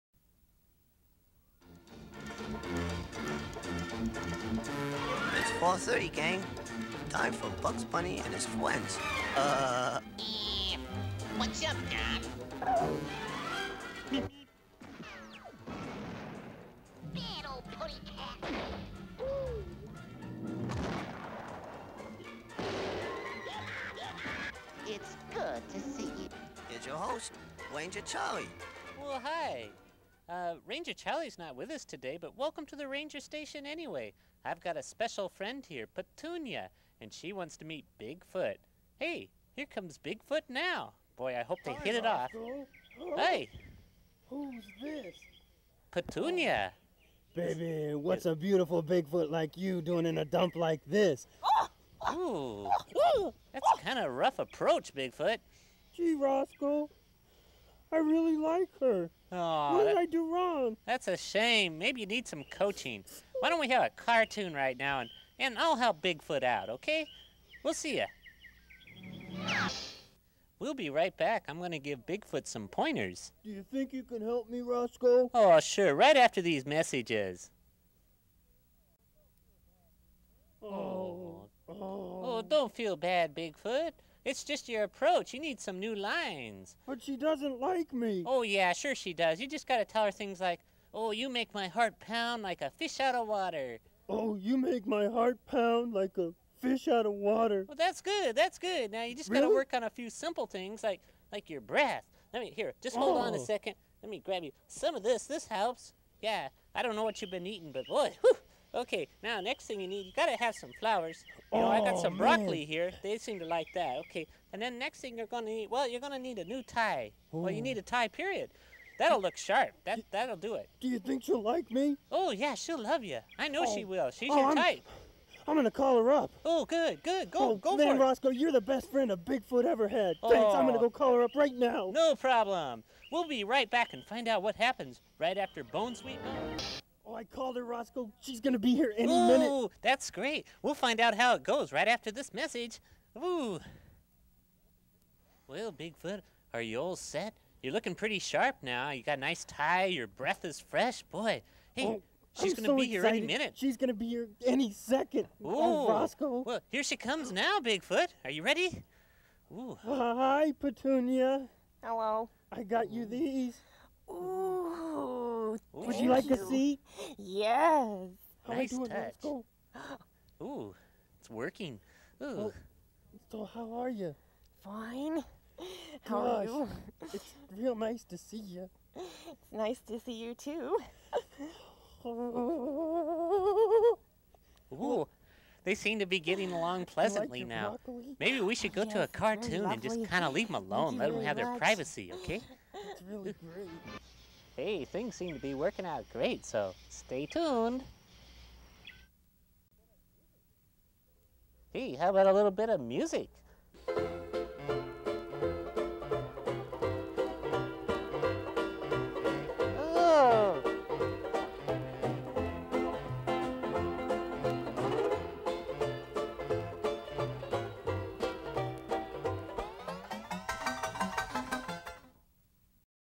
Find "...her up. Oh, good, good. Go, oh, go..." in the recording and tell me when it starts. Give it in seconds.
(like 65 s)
126 s.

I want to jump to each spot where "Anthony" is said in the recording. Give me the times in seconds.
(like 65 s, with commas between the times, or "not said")
not said.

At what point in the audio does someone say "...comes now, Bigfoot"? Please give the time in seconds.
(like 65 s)
156 s.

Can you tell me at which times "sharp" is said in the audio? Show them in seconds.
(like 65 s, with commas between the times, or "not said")
119 s, 148 s.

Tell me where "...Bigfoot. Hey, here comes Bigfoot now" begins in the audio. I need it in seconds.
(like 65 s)
37 s.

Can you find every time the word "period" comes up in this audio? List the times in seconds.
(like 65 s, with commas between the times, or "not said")
118 s.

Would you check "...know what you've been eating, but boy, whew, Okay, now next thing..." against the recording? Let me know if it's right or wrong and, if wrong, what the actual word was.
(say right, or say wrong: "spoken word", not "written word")
right.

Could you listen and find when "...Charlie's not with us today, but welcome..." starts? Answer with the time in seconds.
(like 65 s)
30 s.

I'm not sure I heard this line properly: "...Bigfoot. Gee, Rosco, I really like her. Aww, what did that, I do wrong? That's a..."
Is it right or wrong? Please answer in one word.
right.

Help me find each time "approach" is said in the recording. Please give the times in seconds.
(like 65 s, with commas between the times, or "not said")
54 s, 84 s.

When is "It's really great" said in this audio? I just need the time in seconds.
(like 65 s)
192 s.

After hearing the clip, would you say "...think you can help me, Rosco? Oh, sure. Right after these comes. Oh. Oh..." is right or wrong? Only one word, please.
wrong.